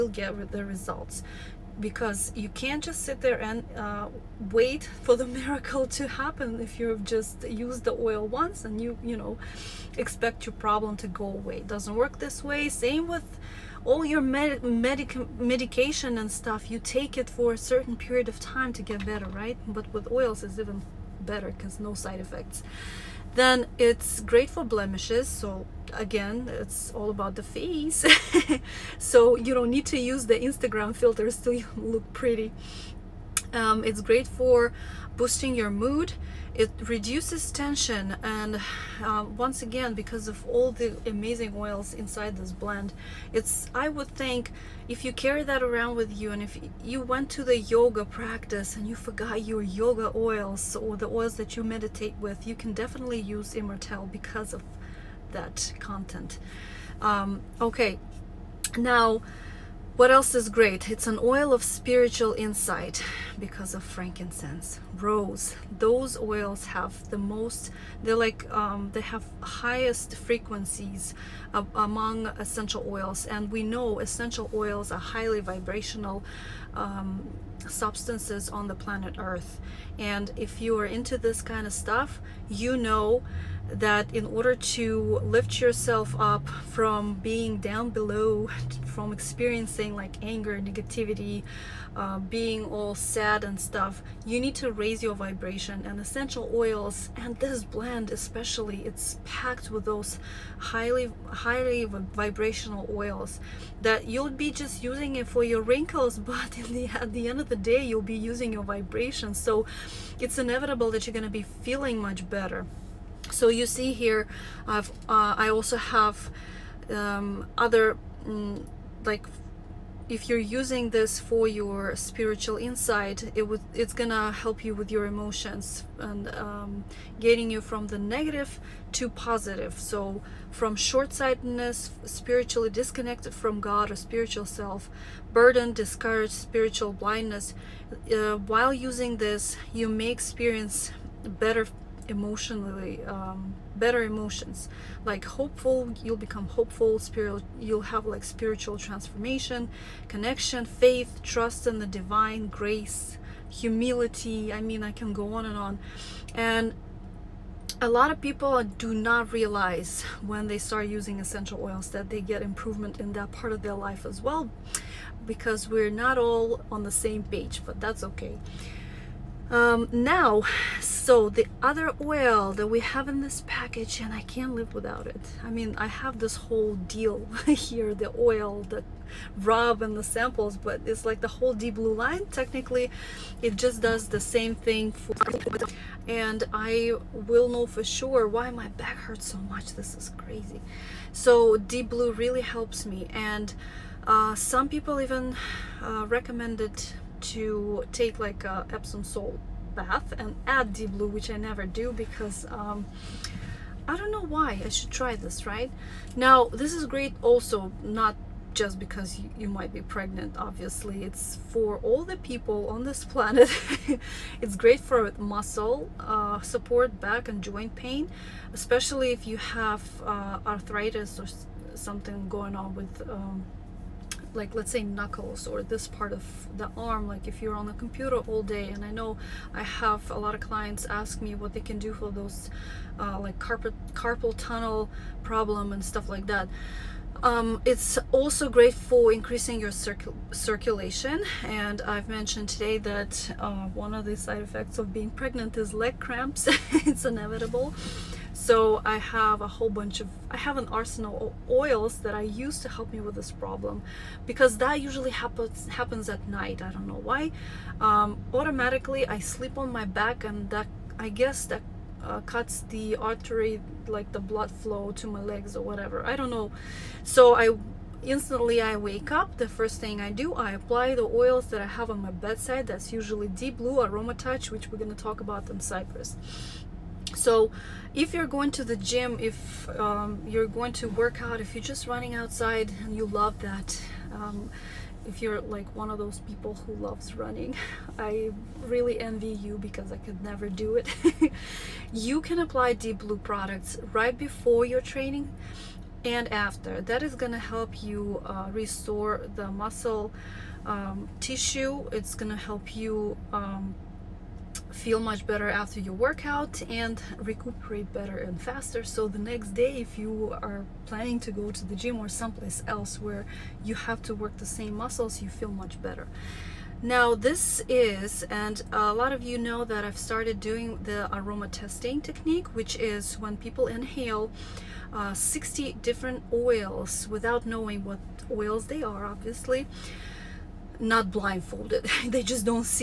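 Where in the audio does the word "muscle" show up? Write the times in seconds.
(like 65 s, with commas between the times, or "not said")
215 s, 299 s, 314 s.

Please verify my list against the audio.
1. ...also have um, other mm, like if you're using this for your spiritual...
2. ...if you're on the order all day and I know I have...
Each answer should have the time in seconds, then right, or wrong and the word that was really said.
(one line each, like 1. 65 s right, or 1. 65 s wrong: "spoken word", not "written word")
1. 115 s right
2. 227 s wrong: "computer", not "order".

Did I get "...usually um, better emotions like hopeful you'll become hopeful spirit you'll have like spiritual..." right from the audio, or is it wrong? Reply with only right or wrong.
wrong.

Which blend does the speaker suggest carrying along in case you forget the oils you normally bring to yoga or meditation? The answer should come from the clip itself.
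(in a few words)
Immortelle.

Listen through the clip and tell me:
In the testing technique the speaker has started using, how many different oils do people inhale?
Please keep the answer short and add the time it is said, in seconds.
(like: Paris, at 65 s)
60, at 325 s.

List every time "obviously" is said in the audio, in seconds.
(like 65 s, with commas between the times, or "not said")
210 s, 329 s.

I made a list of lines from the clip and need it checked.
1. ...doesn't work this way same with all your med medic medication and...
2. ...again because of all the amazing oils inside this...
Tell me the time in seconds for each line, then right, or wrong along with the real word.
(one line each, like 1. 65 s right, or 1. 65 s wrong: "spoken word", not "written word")
1. 11 s right
2. 39 s right.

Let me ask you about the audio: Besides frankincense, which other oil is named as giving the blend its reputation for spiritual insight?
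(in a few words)
rose.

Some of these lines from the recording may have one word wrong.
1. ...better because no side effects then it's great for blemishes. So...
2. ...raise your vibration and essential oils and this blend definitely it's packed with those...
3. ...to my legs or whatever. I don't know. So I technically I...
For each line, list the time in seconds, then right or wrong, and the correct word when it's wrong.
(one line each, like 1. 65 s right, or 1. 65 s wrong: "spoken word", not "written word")
1. 21 s right
2. 94 s wrong: "especially", not "definitely"
3. 264 s wrong: "instantly", not "technically".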